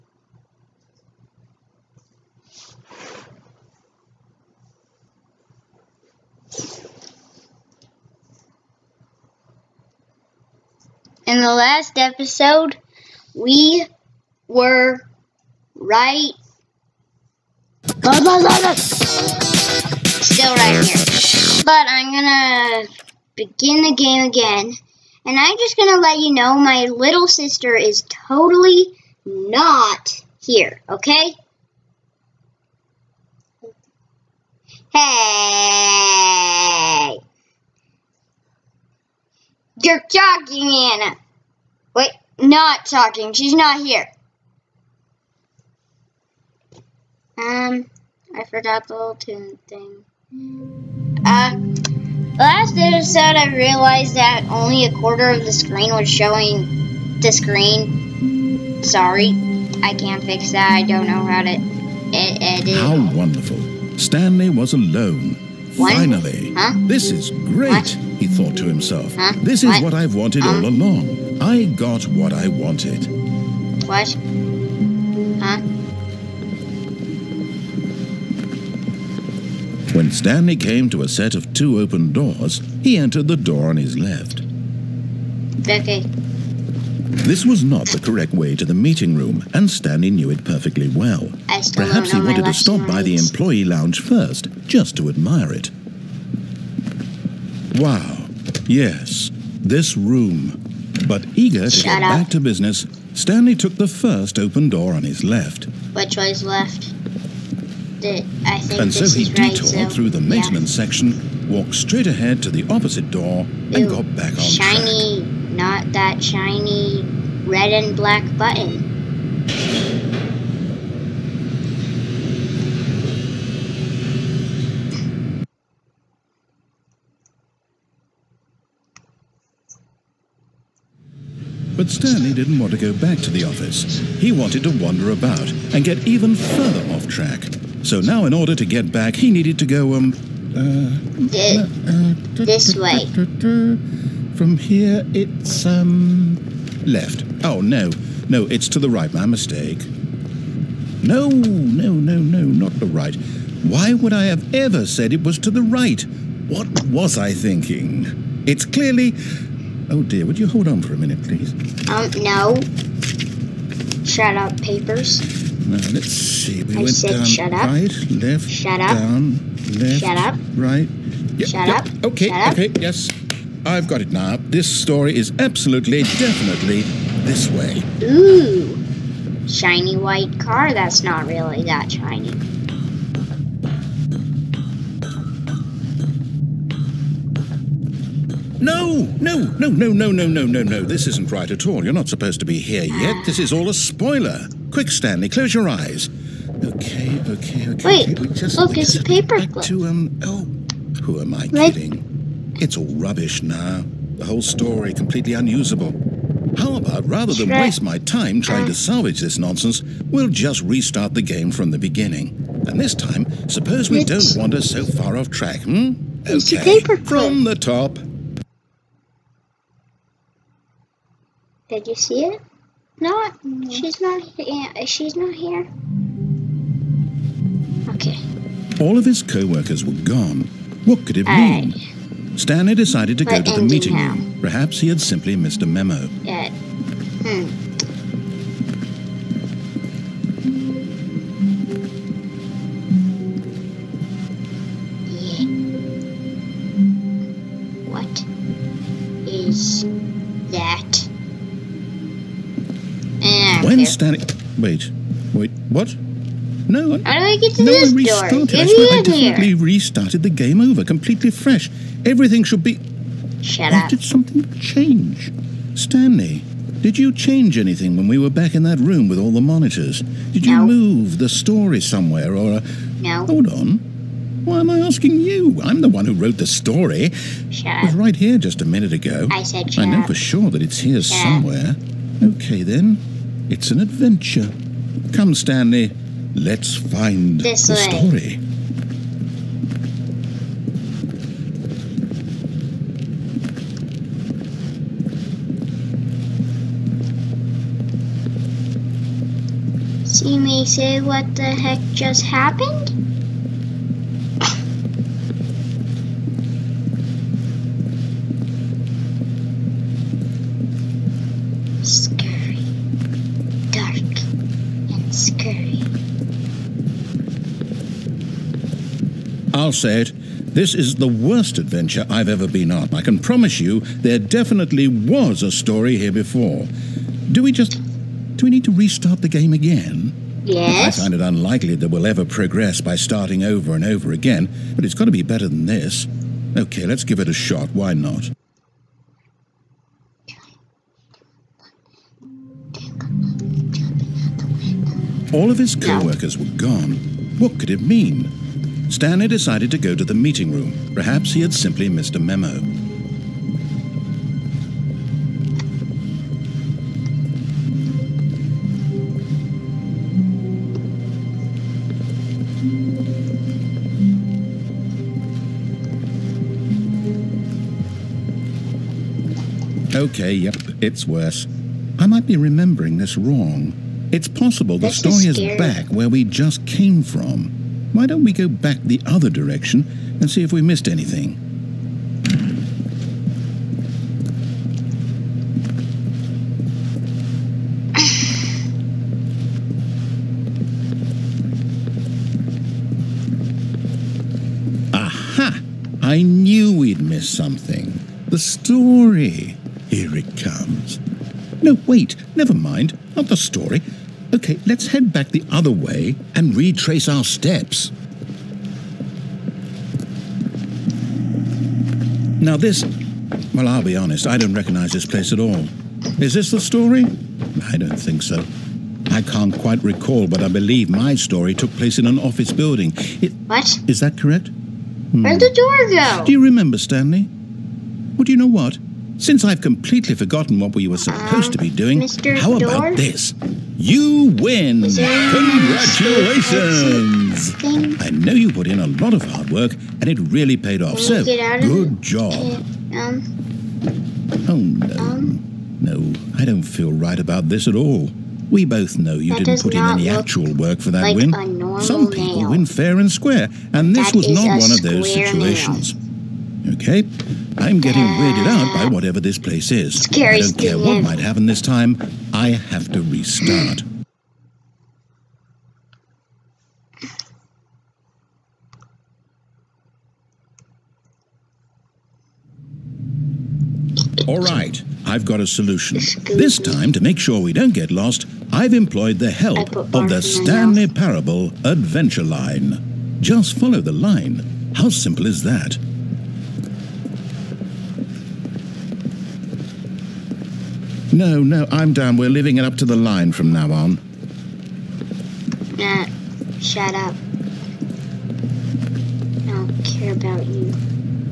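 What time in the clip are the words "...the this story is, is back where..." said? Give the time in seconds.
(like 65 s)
374 s.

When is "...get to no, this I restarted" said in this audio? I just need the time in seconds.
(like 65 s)
257 s.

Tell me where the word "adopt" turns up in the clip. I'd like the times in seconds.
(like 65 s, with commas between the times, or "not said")
not said.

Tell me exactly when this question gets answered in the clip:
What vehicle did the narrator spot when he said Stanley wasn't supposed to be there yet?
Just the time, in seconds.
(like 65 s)
179 s.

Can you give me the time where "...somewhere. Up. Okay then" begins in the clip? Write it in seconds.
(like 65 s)
281 s.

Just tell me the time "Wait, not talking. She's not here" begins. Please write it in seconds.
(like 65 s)
41 s.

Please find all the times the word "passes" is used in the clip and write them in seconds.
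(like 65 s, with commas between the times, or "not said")
not said.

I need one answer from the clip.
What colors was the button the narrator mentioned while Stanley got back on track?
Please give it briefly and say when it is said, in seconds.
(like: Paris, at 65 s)
red and black, at 117 s.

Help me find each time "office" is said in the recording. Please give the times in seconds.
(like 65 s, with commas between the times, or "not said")
133 s, 422 s.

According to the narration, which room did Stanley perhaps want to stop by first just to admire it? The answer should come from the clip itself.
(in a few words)
employee lounge.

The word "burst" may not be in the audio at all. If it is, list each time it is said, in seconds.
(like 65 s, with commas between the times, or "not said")
not said.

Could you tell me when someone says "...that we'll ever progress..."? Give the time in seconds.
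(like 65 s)
331 s.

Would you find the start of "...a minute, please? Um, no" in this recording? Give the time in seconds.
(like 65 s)
160 s.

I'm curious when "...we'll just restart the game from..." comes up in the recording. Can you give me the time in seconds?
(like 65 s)
210 s.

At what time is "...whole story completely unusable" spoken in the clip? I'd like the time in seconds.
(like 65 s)
204 s.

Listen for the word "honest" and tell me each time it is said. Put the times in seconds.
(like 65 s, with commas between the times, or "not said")
413 s.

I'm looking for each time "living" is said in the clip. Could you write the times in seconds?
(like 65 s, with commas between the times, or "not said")
492 s.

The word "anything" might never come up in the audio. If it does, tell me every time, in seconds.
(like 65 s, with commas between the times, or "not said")
267 s, 380 s.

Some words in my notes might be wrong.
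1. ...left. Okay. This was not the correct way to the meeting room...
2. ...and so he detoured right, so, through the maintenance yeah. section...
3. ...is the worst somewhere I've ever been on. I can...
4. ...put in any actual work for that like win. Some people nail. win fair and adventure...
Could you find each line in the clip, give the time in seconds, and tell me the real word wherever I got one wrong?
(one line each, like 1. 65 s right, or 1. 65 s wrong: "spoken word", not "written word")
1. 83 s right
2. 108 s right
3. 320 s wrong: "adventure", not "somewhere"
4. 449 s wrong: "square", not "adventure".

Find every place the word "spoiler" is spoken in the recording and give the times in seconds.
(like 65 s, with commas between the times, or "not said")
193 s.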